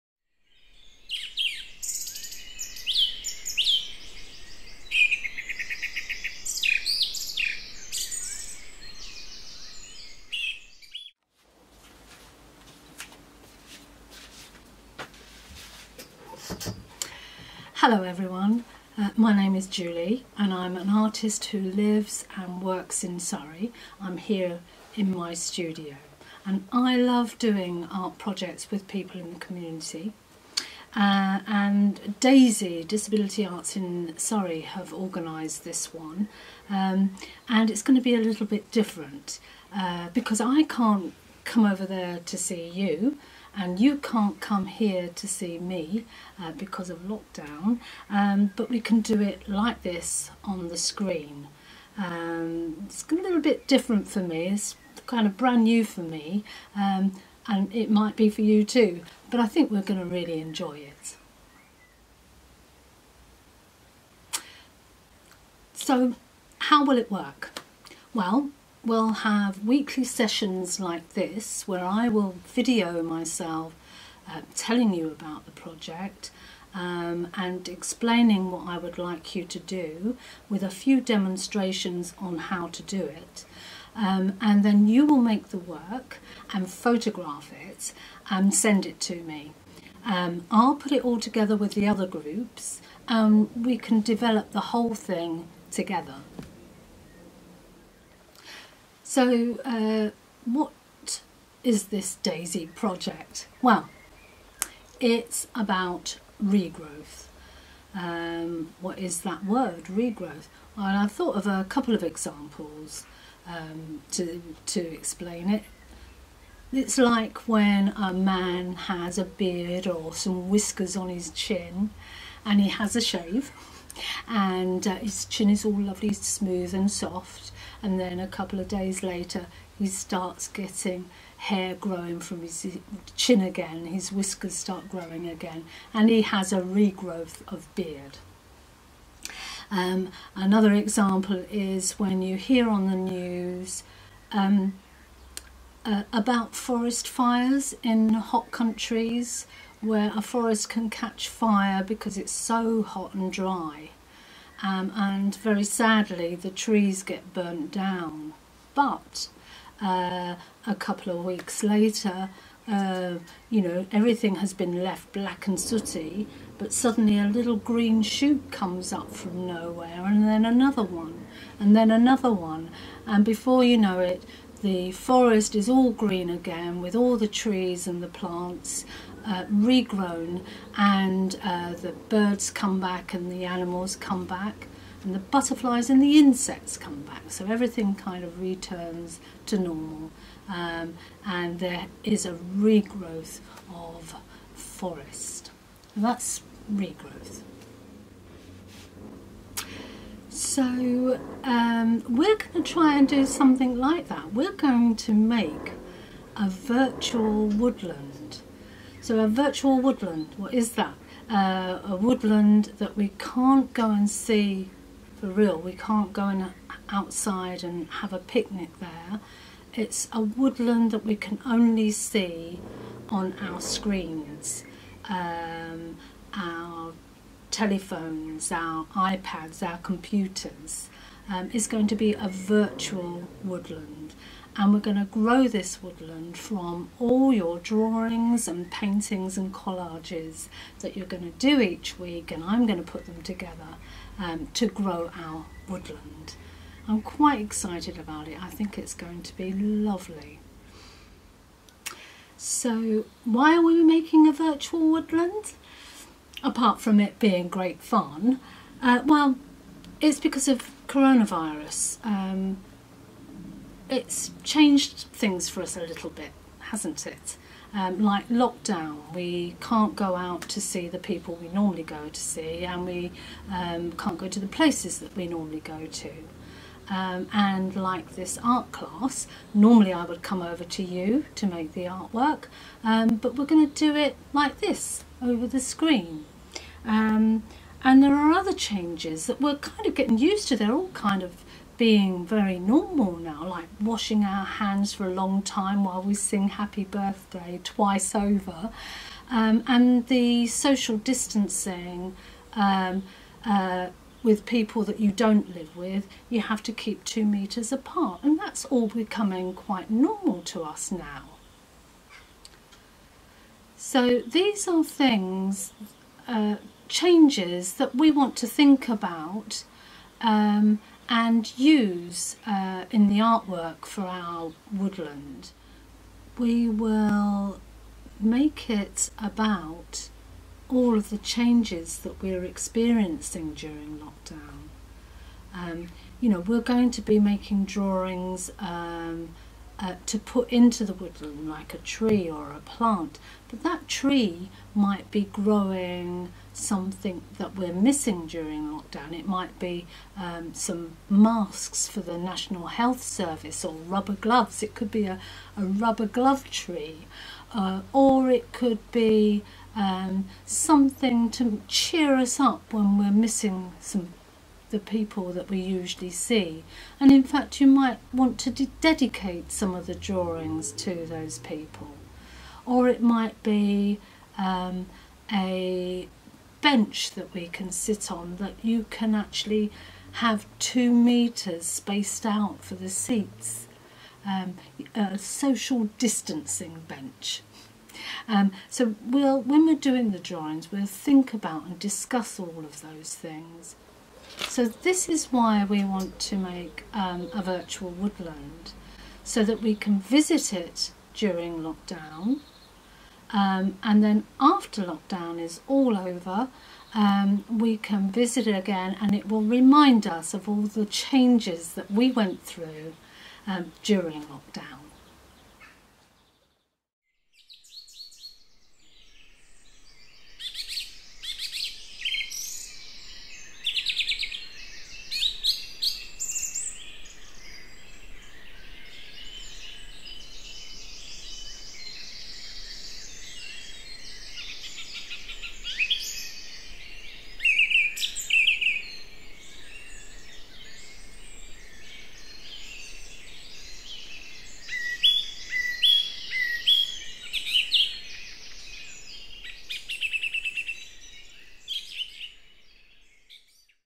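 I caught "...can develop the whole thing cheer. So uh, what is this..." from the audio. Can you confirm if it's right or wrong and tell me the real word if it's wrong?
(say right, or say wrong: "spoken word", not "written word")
wrong: "together", not "cheer".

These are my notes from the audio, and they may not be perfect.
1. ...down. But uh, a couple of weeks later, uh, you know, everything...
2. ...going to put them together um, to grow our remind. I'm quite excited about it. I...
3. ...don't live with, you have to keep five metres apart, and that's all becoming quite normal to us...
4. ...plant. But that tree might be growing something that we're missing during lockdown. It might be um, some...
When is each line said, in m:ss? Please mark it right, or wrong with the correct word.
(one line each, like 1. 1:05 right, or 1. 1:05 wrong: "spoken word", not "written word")
1. 2:37 right
2. 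4:02 wrong: "woodland", not "remind"
3. 5:05 wrong: "two", not "five"
4. 5:42 right.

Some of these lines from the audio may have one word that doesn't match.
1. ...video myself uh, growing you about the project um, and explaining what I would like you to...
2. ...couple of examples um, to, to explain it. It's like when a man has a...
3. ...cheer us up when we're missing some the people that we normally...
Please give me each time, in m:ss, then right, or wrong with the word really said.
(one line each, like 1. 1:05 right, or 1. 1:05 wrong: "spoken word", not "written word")
1. 1:12 wrong: "telling", not "growing"
2. 1:51 right
3. 6:01 wrong: "usually", not "normally".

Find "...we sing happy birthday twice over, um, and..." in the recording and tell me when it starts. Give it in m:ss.
4:56.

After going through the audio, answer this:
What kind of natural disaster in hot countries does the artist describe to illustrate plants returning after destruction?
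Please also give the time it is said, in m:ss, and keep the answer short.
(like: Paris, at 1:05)
Forest fires, at 2:26.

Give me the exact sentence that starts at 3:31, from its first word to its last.
Uh, a woodland that we can't go and see for real.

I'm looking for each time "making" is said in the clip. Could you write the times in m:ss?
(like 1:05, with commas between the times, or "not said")
4:13, 5:37.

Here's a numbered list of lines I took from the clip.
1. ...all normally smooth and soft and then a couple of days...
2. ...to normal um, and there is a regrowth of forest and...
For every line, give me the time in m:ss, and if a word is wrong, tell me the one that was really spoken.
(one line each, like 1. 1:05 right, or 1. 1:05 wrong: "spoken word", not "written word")
1. 2:05 wrong: "lovely", not "normally"
2. 3:09 right.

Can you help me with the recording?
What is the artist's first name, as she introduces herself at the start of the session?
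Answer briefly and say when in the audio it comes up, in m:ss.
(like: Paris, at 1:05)
Julie, at 0:19.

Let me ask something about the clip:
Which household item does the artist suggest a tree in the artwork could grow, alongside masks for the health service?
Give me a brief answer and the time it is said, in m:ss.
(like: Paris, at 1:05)
Rubber gloves, at 5:53.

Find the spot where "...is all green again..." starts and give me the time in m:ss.
2:55.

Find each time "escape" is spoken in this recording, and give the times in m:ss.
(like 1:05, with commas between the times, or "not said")
not said.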